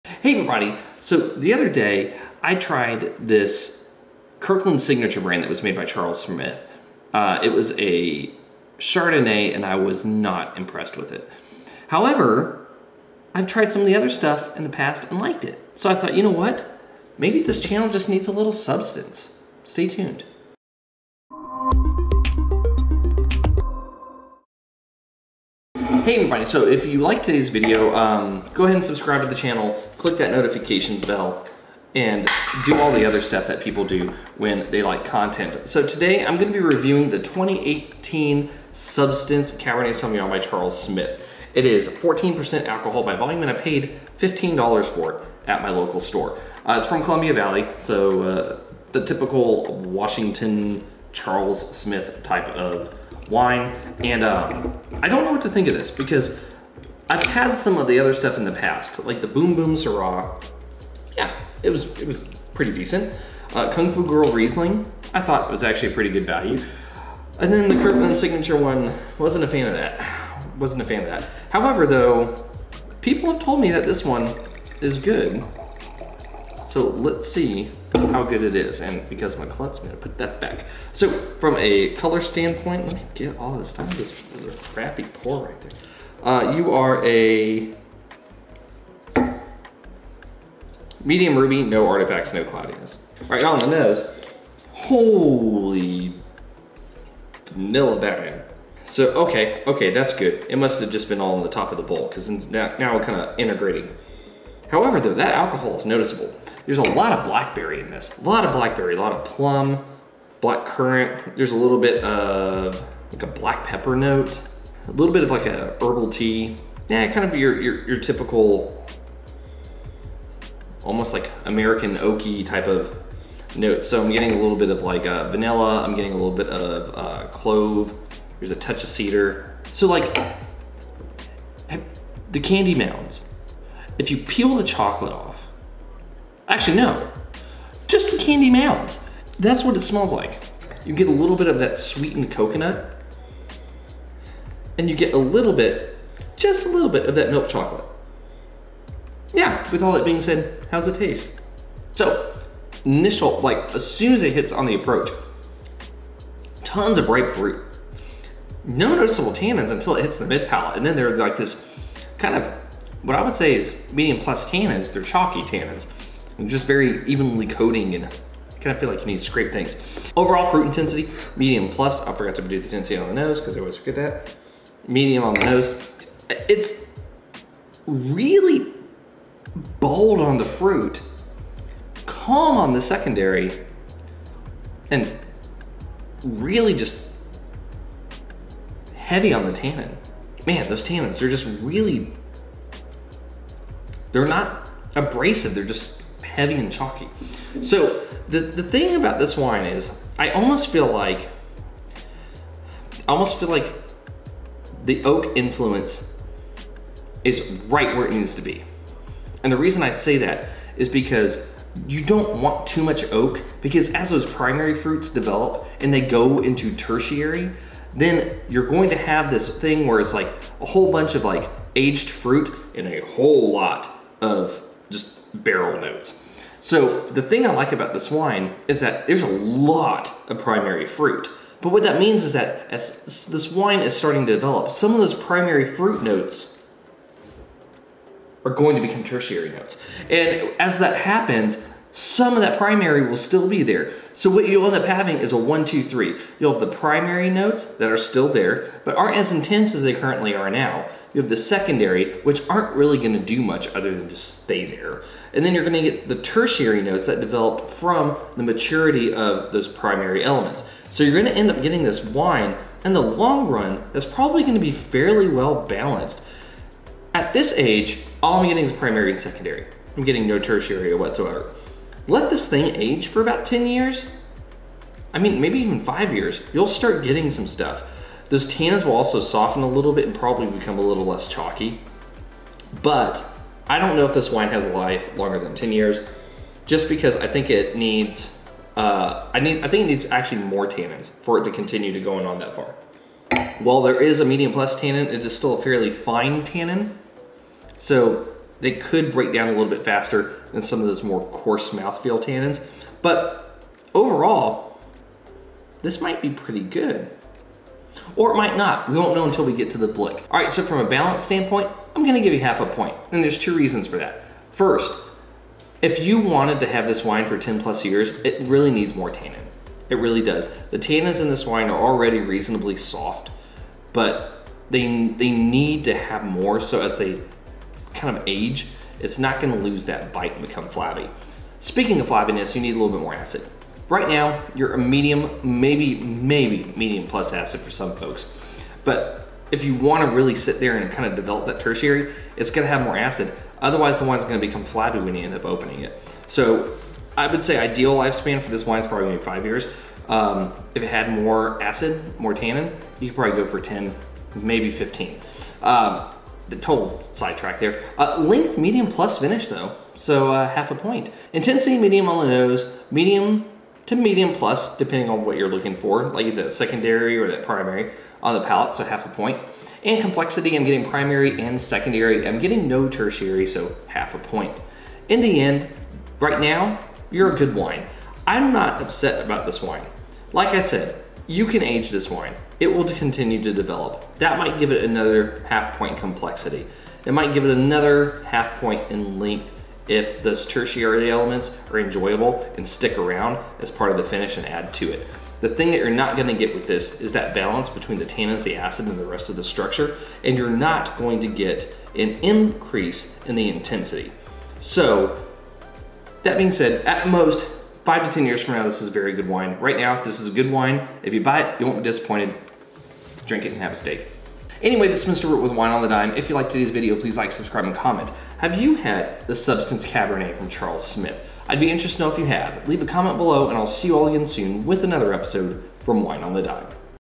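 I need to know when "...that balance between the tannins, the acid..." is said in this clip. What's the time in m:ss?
6:37.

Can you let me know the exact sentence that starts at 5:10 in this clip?
All right, so from a balance standpoint, I'm gonna give you half a point.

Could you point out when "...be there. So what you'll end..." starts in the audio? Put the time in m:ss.
4:03.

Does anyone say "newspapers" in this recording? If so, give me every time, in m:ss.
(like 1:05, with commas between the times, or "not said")
not said.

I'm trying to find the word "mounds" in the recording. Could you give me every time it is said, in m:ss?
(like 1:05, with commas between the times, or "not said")
2:12, 2:18.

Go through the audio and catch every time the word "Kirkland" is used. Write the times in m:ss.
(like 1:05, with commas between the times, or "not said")
0:04, 1:07.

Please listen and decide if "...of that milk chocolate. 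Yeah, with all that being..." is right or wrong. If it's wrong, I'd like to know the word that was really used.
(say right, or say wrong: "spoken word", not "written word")
right.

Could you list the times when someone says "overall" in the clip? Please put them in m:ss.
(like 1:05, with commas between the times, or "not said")
2:50, 5:03.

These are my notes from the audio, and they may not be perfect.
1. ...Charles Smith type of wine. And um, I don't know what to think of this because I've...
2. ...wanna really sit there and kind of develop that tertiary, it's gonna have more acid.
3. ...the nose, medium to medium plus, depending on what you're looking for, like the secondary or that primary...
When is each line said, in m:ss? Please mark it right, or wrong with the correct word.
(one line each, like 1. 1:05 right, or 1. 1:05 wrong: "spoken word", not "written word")
1. 0:51 right
2. 5:39 right
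3. 6:02 right.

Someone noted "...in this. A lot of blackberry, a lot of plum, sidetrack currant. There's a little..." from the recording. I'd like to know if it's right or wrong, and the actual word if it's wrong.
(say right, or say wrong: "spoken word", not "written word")
wrong: "black", not "sidetrack".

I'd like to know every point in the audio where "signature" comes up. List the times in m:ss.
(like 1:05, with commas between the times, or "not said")
0:04, 1:08.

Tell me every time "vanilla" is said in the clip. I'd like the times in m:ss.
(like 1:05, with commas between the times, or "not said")
1:37, 2:05.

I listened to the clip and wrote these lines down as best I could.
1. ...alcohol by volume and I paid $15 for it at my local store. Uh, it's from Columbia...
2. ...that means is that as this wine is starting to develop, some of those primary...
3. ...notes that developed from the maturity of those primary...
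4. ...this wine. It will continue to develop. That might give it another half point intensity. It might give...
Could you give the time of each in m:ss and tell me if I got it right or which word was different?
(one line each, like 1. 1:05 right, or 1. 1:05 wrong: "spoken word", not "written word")
1. 0:42 right
2. 3:51 right
3. 4:16 right
4. 6:21 wrong: "complexity", not "intensity".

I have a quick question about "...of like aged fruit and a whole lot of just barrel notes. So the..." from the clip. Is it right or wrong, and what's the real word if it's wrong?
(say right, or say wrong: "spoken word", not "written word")
right.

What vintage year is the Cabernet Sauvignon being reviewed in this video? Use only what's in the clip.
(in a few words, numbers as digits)
2018.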